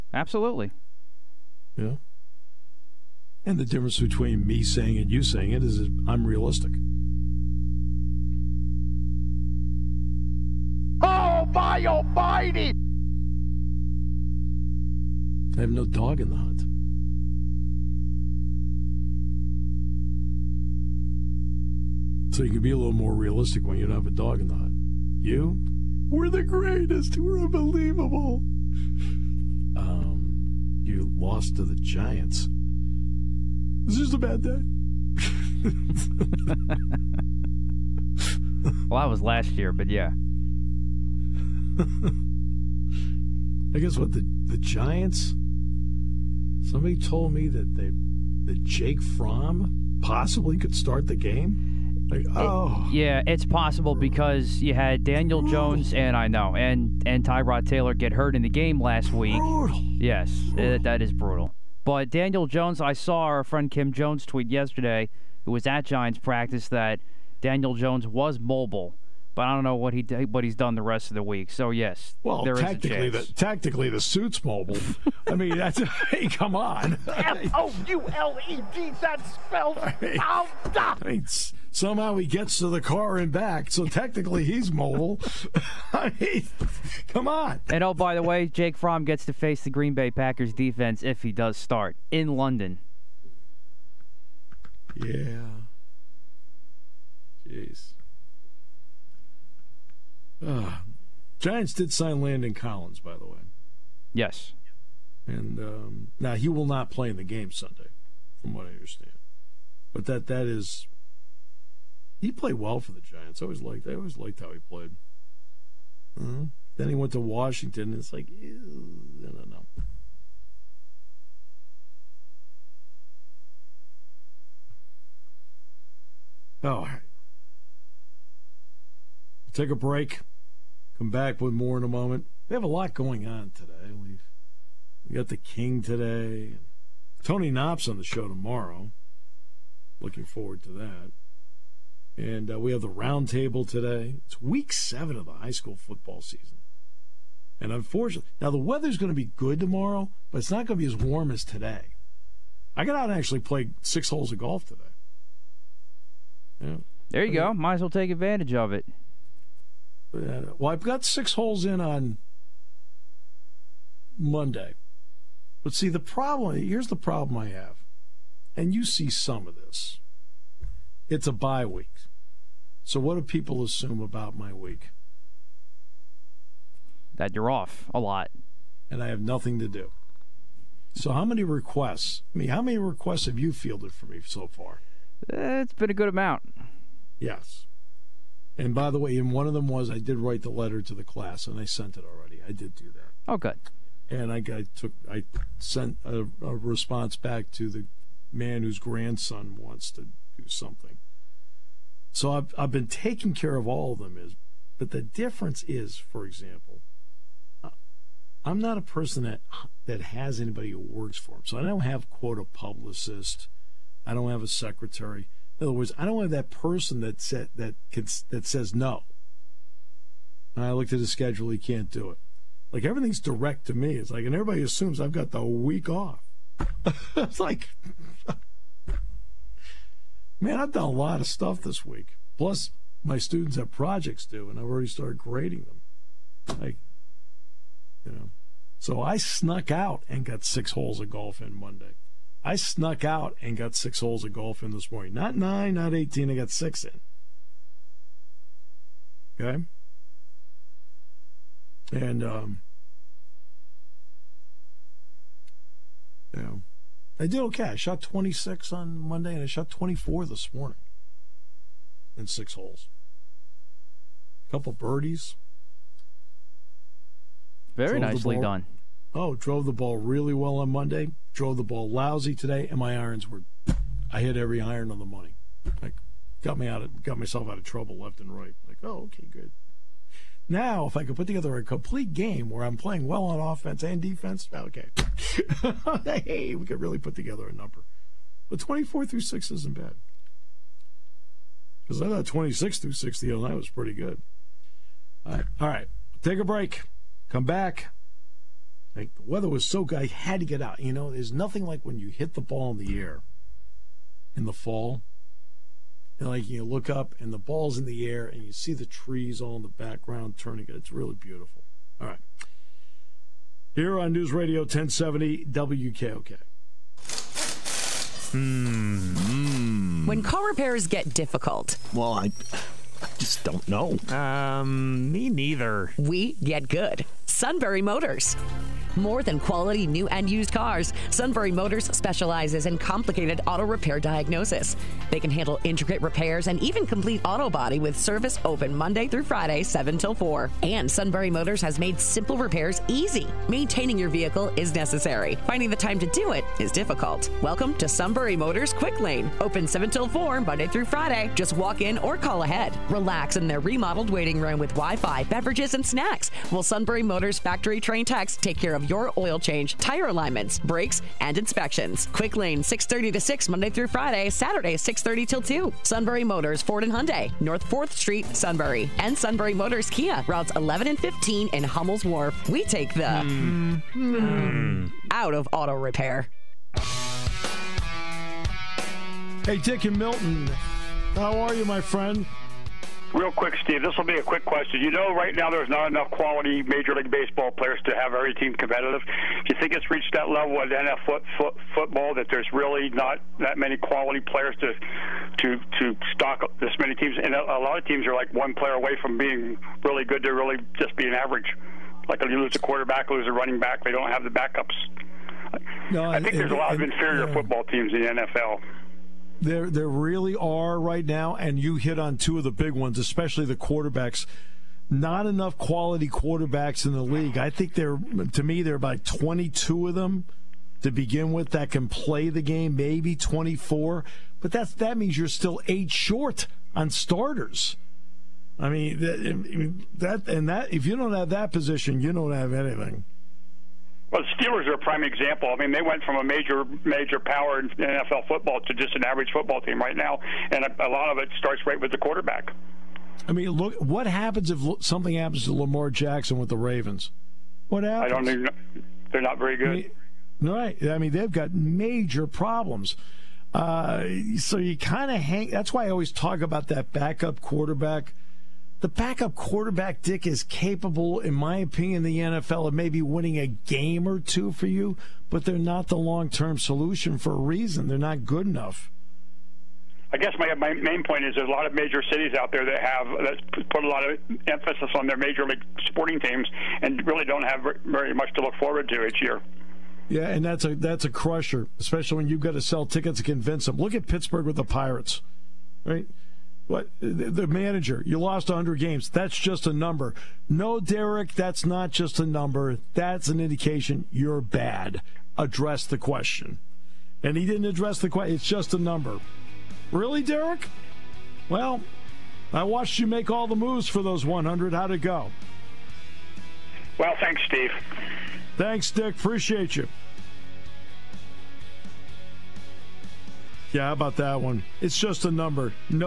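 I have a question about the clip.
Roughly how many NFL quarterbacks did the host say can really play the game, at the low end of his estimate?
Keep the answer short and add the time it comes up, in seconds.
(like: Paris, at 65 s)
22, at 419 s.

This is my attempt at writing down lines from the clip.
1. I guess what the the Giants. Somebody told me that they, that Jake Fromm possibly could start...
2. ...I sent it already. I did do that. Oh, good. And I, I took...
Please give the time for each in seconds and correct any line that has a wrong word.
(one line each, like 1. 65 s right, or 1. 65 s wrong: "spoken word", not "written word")
1. 41 s right
2. 191 s right.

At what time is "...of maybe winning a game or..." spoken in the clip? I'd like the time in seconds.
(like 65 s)
462 s.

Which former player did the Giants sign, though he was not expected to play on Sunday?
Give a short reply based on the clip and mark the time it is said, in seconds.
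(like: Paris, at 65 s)
Landon Collins, at 102 s.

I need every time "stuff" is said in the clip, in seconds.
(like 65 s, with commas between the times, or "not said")
231 s.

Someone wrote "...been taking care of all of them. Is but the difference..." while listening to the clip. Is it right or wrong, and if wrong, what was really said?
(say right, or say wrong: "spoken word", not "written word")
right.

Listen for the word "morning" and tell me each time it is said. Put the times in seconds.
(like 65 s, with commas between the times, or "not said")
244 s, 260 s.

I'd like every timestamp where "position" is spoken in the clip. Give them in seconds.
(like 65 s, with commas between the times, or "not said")
431 s.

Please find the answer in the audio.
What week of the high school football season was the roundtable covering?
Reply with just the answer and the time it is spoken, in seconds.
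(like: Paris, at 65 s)
Week 7, at 144 s.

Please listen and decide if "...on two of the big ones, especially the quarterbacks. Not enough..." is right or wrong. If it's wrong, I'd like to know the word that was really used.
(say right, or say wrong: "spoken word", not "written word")
right.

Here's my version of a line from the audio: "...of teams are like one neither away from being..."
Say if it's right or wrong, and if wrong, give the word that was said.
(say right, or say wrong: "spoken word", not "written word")
wrong: "player", not "neither".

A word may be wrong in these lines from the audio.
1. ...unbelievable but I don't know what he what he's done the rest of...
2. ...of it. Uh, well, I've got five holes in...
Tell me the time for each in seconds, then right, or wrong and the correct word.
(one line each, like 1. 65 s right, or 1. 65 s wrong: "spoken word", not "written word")
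1. 68 s wrong: "mobile", not "unbelievable"
2. 158 s wrong: "six", not "five".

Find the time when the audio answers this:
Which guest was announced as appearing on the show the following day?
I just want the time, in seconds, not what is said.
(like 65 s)
137 s.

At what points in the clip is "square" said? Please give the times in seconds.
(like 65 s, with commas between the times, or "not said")
not said.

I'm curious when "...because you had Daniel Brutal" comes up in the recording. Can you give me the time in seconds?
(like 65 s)
53 s.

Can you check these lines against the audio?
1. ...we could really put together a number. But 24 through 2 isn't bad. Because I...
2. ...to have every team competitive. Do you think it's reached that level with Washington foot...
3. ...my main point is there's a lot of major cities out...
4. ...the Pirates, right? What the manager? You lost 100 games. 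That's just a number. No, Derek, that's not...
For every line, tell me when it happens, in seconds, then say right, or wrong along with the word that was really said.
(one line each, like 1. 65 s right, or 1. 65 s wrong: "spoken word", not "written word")
1. 286 s wrong: "6", not "2"
2. 387 s wrong: "NFL", not "Washington"
3. 470 s right
4. 484 s right.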